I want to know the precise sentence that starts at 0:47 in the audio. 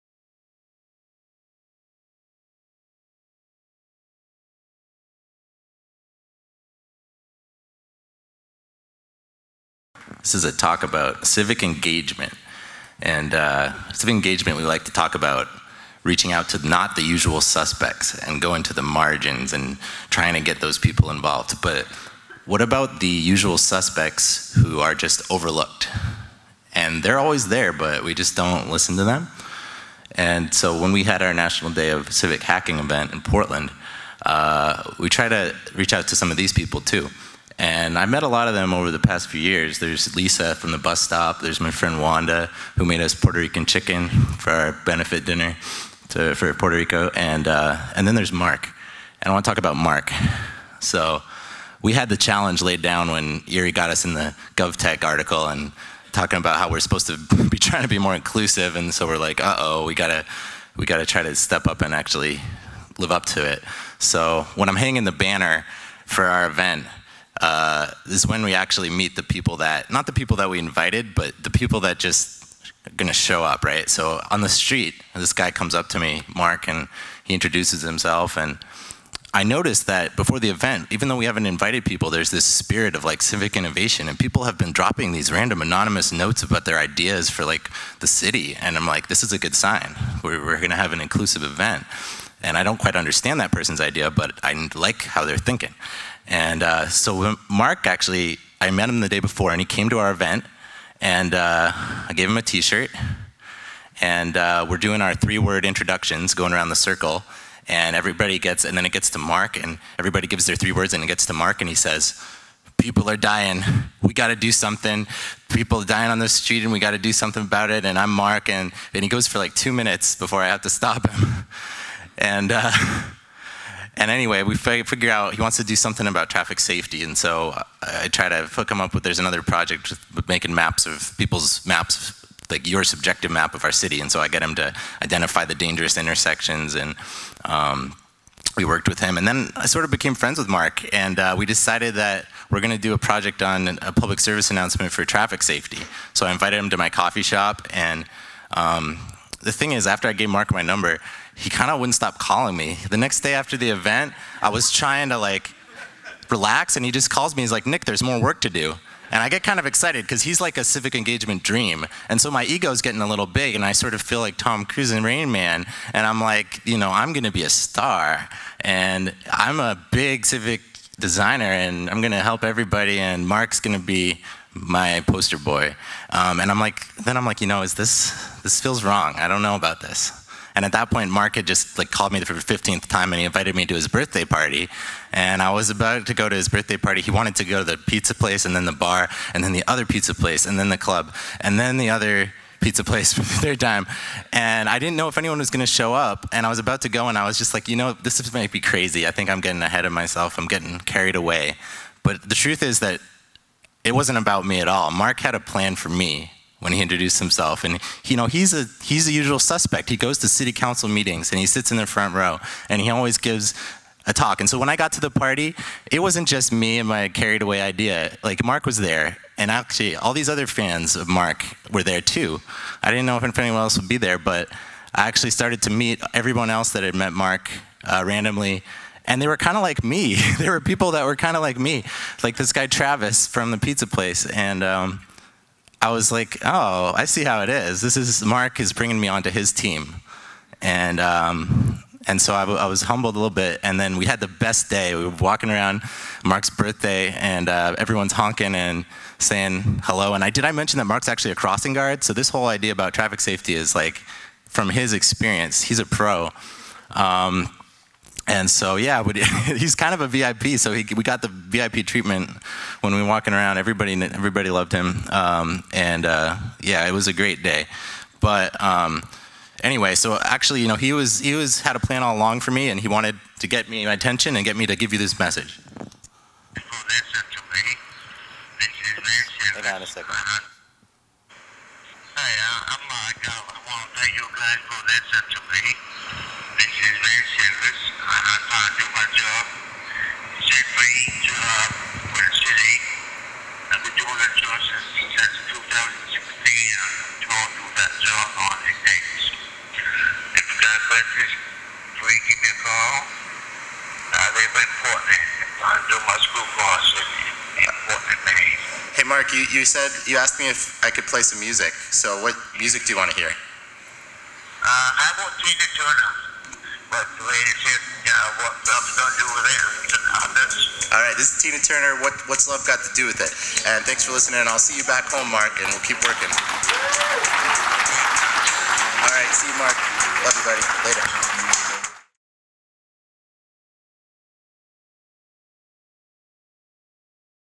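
And, uh, and then there's Mark.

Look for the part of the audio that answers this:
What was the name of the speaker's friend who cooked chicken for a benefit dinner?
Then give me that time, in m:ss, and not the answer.
0:42.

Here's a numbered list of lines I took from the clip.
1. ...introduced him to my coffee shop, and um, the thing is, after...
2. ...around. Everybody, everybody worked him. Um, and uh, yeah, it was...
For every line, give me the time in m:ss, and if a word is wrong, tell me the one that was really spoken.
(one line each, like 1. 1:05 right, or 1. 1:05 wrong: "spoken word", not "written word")
1. 2:26 wrong: "invited", not "introduced"
2. 4:23 wrong: "loved", not "worked".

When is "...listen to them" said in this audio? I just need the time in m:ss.
0:28.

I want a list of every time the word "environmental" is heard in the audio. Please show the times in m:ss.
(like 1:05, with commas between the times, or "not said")
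not said.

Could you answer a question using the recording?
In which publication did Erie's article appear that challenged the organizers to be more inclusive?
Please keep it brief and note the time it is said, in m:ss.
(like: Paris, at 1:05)
GovTech, at 0:54.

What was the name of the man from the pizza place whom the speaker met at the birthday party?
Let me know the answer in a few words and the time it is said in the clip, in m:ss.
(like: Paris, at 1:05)
Travis, at 3:52.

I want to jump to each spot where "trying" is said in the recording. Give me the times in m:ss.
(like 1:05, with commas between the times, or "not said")
0:20, 0:57, 2:34.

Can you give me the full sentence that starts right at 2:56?
Um, and I'm like, then I'm like, you know, is this, this feels wrong.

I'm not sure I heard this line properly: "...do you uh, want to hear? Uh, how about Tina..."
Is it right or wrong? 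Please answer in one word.
right.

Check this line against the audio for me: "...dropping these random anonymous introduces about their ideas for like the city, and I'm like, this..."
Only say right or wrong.
wrong.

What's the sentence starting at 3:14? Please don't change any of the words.
And I didn't know if anyone was going to show up.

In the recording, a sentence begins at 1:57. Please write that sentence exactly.
And I'm Mark, and, and he goes for like two minutes before I have to stop him.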